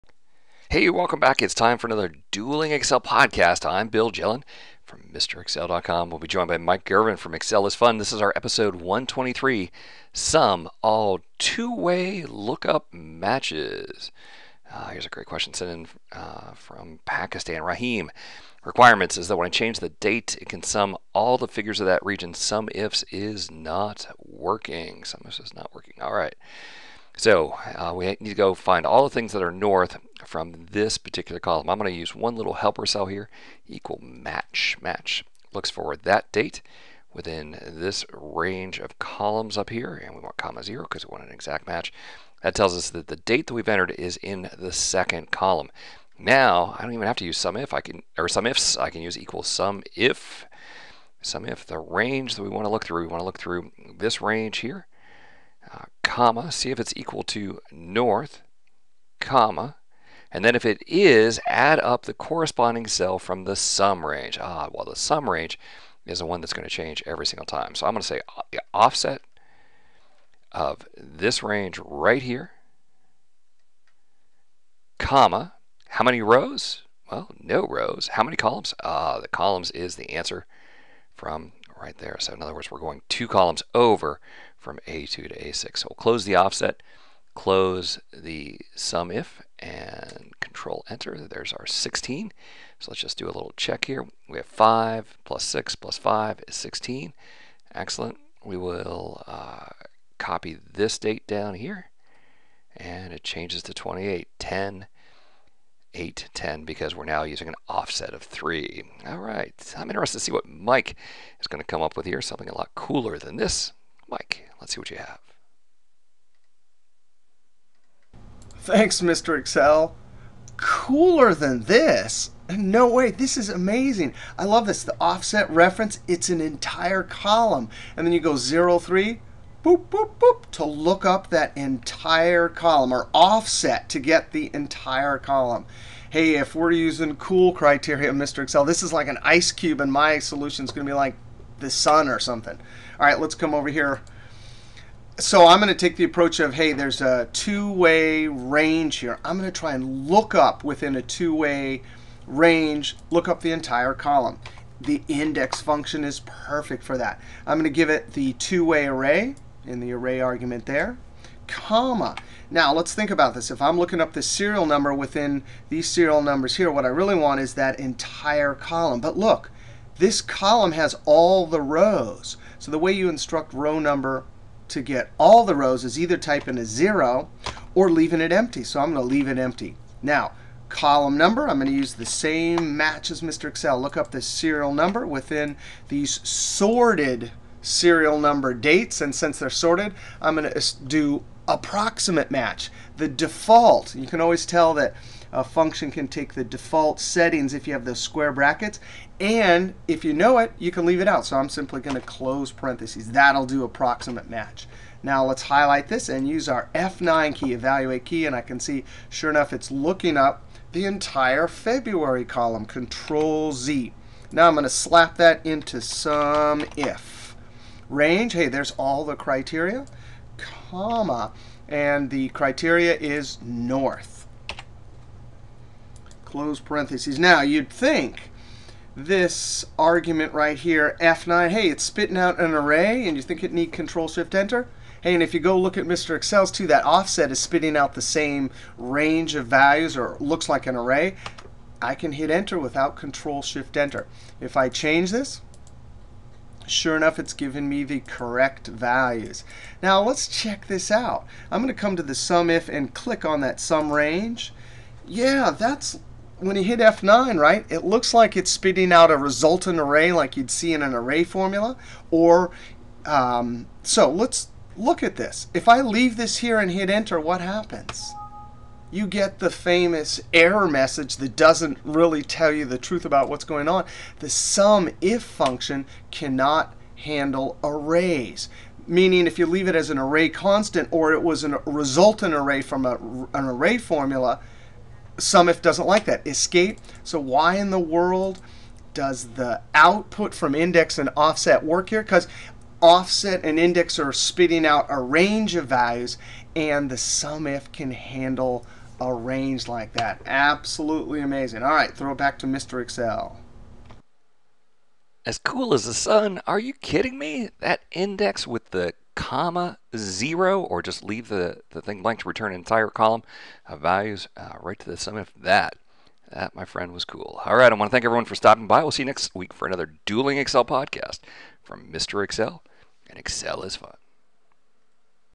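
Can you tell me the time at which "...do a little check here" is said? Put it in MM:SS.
01:33.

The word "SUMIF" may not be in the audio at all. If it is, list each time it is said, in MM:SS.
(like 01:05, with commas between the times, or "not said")
04:45, 04:56.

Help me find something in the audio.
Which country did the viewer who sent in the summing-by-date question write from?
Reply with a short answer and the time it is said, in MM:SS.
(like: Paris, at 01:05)
Pakistan, at 00:17.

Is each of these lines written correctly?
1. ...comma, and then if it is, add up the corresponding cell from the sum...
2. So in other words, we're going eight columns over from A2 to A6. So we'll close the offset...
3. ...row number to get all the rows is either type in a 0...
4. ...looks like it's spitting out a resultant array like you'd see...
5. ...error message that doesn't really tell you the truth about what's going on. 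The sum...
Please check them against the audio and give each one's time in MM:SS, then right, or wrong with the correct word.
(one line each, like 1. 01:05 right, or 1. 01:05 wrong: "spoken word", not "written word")
1. 00:59 right
2. 01:22 wrong: "two", not "eight"
3. 02:53 right
4. 04:17 right
5. 04:30 right.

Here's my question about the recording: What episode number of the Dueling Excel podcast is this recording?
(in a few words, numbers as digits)
123.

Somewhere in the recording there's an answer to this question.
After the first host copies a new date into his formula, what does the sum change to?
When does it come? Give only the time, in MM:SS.
01:43.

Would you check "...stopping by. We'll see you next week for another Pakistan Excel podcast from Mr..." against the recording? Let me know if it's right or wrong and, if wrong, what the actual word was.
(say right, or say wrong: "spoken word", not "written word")
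wrong: "Dueling", not "Pakistan".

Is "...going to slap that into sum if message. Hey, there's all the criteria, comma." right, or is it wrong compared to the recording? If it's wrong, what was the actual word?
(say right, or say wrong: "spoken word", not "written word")
wrong: "range", not "message".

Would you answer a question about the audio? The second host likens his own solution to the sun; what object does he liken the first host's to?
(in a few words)
an ice cube.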